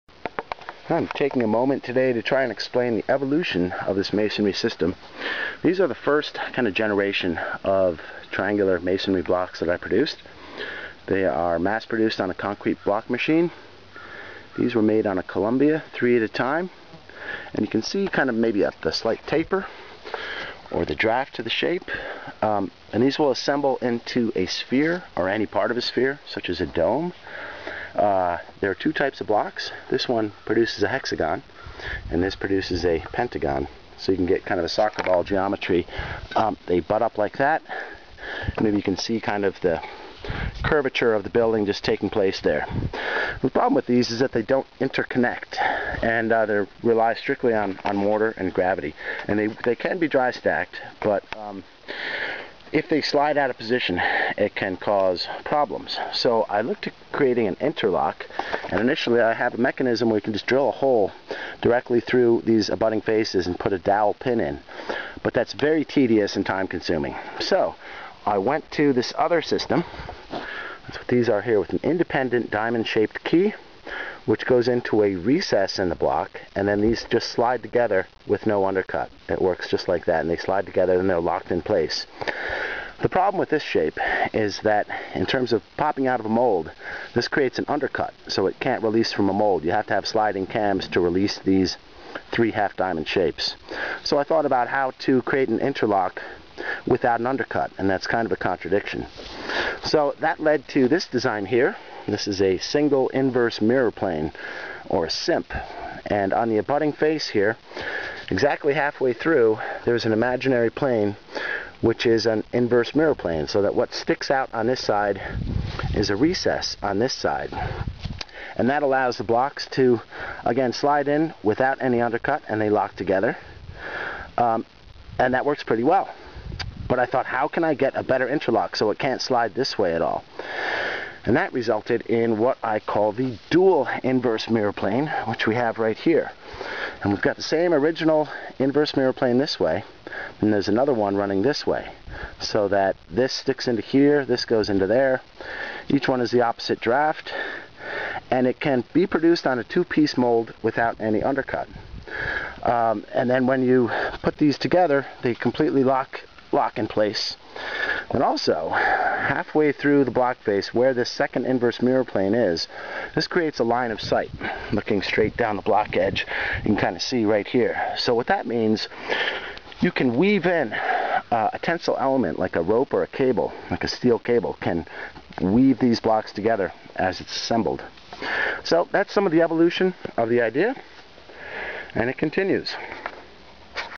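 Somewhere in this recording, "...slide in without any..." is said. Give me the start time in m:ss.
2:00.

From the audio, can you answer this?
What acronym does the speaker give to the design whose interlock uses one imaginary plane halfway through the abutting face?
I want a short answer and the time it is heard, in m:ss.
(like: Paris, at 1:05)
SIMP, at 1:45.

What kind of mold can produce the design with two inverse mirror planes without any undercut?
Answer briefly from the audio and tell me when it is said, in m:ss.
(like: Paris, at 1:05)
two-piece mold, at 2:29.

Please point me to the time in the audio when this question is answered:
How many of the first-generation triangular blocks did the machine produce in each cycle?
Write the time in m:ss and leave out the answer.
0:15.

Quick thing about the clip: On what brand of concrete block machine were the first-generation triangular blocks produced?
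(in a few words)
Columbia.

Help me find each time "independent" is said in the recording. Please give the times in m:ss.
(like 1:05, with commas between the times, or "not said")
1:11.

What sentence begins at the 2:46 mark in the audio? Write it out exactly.
You can kind of see right here.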